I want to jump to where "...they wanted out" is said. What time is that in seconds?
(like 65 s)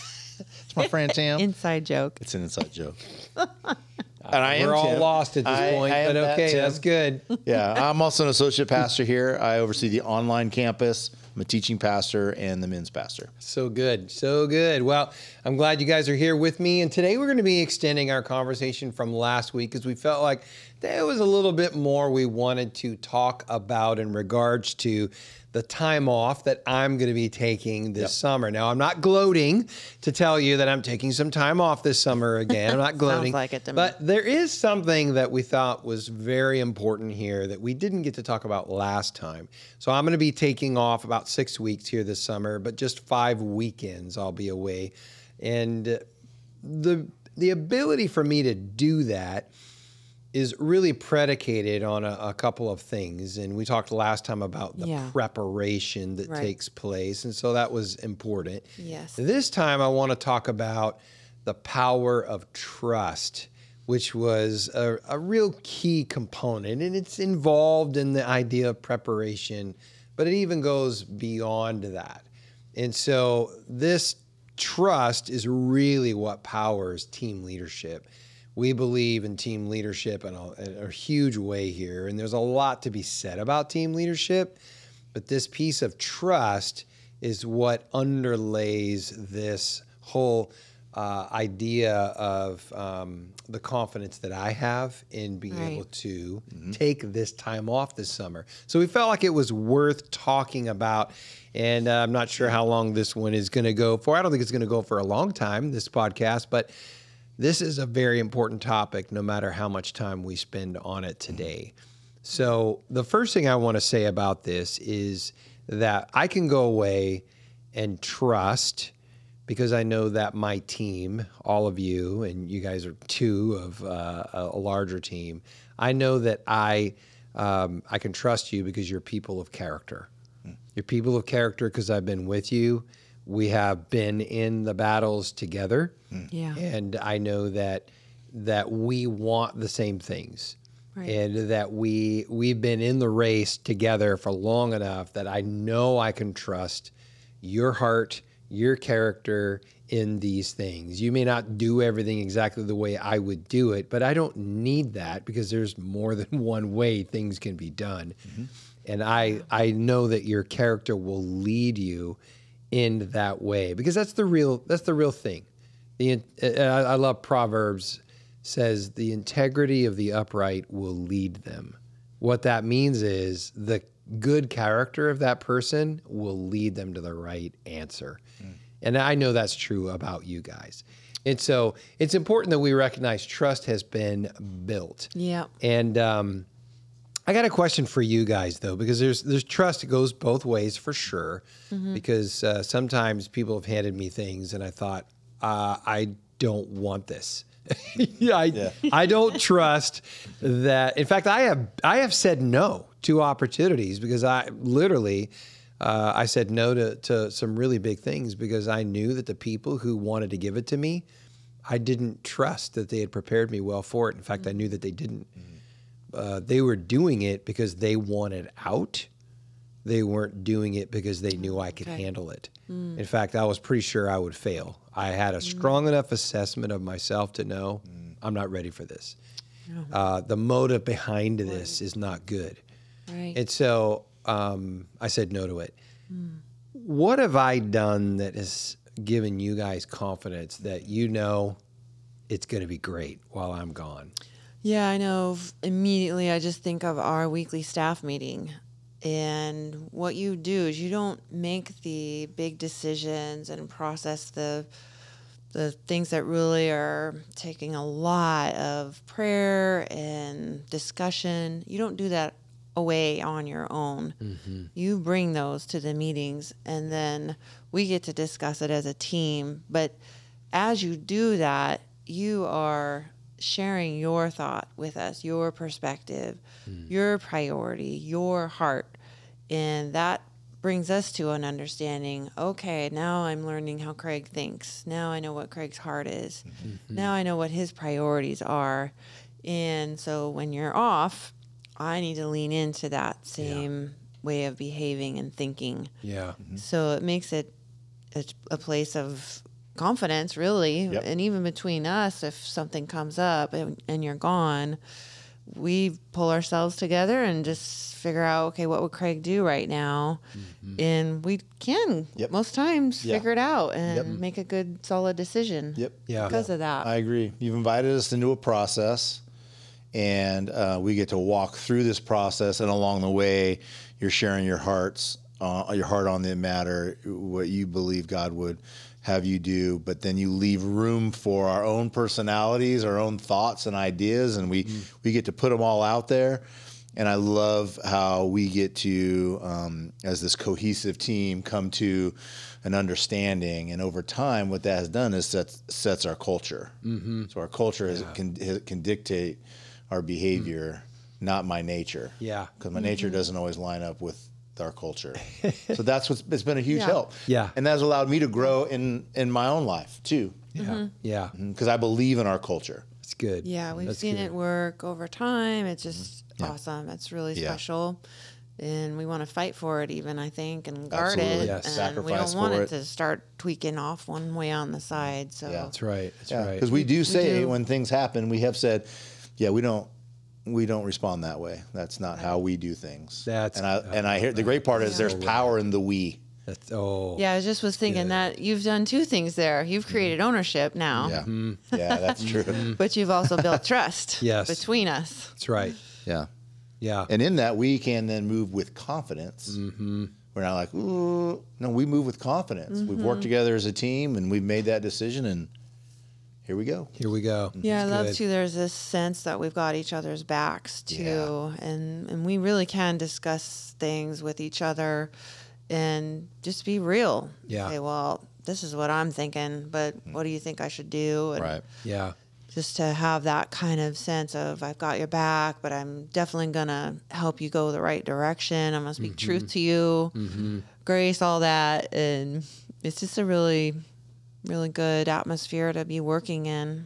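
217 s.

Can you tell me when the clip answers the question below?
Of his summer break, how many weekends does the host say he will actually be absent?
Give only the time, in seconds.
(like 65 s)
43 s.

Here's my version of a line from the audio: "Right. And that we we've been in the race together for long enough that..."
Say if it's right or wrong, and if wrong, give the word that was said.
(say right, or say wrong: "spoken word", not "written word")
right.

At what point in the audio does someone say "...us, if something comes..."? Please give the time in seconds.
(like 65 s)
301 s.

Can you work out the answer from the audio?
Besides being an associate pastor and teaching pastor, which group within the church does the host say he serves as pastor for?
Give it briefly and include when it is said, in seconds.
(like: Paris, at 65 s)
men's pastor, at 12 s.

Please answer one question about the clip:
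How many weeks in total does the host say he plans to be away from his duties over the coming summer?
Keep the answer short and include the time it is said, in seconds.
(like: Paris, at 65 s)
6 weeks, at 41 s.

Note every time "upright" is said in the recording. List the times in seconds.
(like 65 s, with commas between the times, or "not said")
170 s.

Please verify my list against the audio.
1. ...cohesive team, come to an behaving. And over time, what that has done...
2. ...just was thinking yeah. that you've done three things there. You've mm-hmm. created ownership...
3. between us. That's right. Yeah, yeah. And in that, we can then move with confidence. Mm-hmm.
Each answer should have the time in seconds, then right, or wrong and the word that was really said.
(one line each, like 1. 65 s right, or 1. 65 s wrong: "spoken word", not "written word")
1. 340 s wrong: "understanding", not "behaving"
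2. 387 s wrong: "two", not "three"
3. 394 s right.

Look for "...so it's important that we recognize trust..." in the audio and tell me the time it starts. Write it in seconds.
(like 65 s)
181 s.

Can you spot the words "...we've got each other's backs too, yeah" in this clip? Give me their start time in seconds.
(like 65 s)
409 s.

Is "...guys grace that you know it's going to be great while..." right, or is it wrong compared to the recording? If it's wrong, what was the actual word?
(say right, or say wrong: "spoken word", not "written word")
wrong: "confidence", not "grace".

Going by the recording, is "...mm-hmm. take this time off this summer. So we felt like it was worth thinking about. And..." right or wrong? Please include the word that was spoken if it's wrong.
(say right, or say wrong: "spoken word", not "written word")
wrong: "talking", not "thinking".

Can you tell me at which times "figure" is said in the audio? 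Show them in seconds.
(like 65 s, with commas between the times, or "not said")
307 s, 313 s.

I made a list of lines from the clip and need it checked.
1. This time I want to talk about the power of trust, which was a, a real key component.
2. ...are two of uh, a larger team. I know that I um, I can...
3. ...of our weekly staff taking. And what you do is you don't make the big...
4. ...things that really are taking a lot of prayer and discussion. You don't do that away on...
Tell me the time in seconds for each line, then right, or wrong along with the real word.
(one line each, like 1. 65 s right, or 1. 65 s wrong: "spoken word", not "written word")
1. 59 s right
2. 122 s right
3. 246 s wrong: "meeting", not "taking"
4. 255 s right.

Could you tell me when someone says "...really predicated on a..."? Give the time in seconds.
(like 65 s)
50 s.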